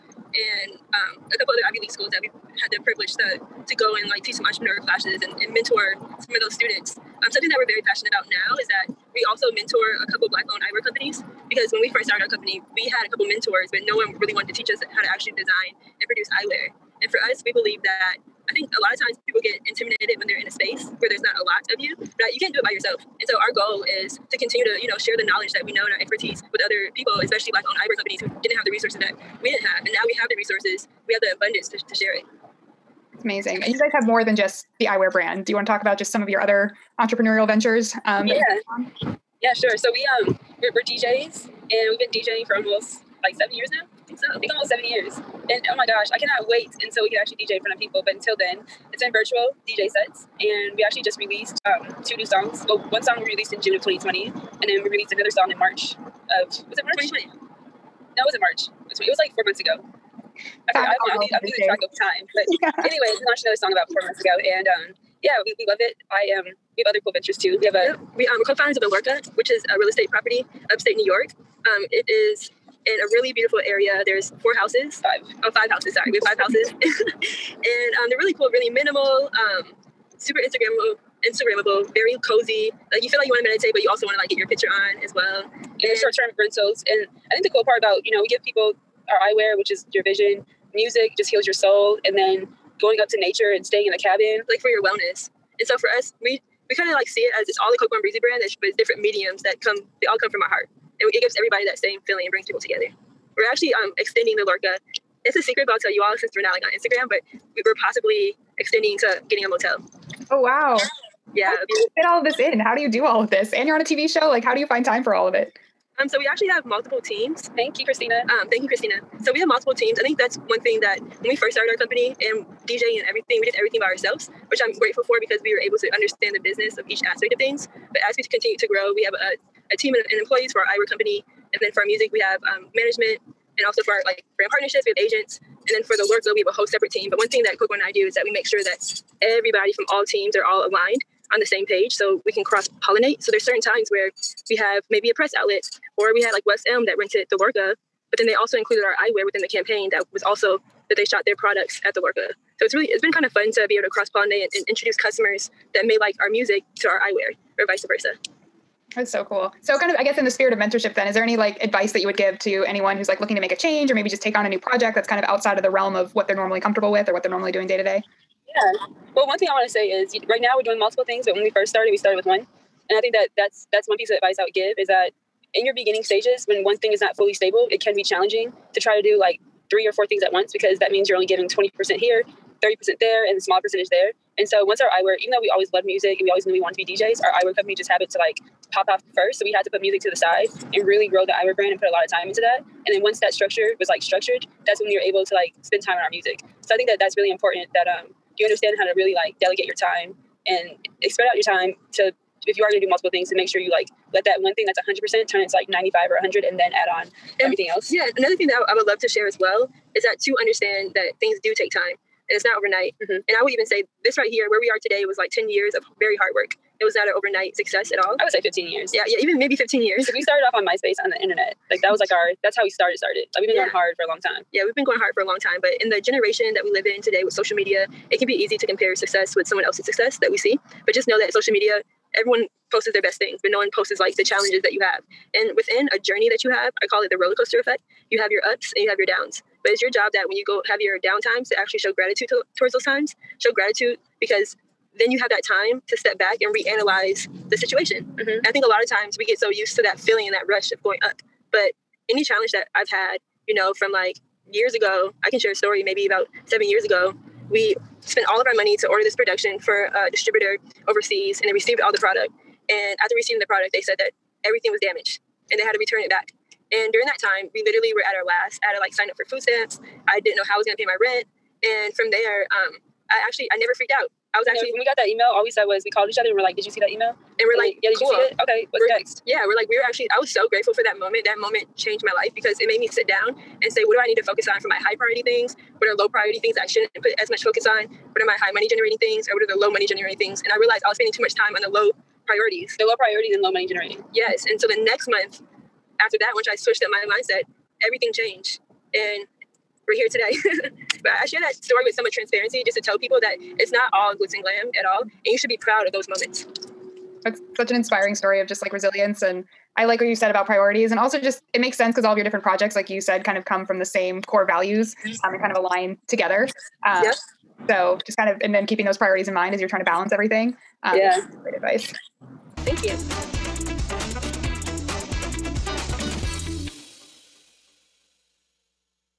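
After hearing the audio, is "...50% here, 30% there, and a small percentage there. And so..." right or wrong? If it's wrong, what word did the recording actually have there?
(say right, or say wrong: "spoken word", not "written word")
wrong: "20", not "50".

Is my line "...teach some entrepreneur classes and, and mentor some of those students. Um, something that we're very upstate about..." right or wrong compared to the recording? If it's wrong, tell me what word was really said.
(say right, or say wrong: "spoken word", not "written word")
wrong: "passionate", not "upstate".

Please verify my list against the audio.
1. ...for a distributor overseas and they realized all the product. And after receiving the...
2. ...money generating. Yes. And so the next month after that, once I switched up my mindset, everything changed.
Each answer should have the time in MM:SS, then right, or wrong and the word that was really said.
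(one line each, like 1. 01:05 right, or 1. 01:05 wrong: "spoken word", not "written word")
1. 04:19 wrong: "received", not "realized"
2. 04:53 right.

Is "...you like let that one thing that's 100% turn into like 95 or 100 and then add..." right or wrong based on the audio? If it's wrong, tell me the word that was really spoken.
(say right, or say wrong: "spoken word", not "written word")
right.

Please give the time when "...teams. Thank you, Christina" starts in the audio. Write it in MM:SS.
01:57.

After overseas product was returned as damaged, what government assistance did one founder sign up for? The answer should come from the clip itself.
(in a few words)
food stamps.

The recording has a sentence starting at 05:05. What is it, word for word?
And you should be proud of those moments.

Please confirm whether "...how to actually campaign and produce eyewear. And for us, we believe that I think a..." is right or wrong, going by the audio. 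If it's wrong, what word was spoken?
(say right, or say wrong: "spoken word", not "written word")
wrong: "design", not "campaign".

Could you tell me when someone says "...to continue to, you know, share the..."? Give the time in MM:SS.
00:24.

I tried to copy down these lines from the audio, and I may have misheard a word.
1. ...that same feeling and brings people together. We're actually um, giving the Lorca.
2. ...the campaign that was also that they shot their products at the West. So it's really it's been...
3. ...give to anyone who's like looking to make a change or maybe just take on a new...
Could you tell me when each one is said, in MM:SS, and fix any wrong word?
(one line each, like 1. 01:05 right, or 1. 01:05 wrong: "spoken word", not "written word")
1. 01:41 wrong: "extending", not "giving"
2. 02:29 wrong: "Lorca", not "West"
3. 02:42 right.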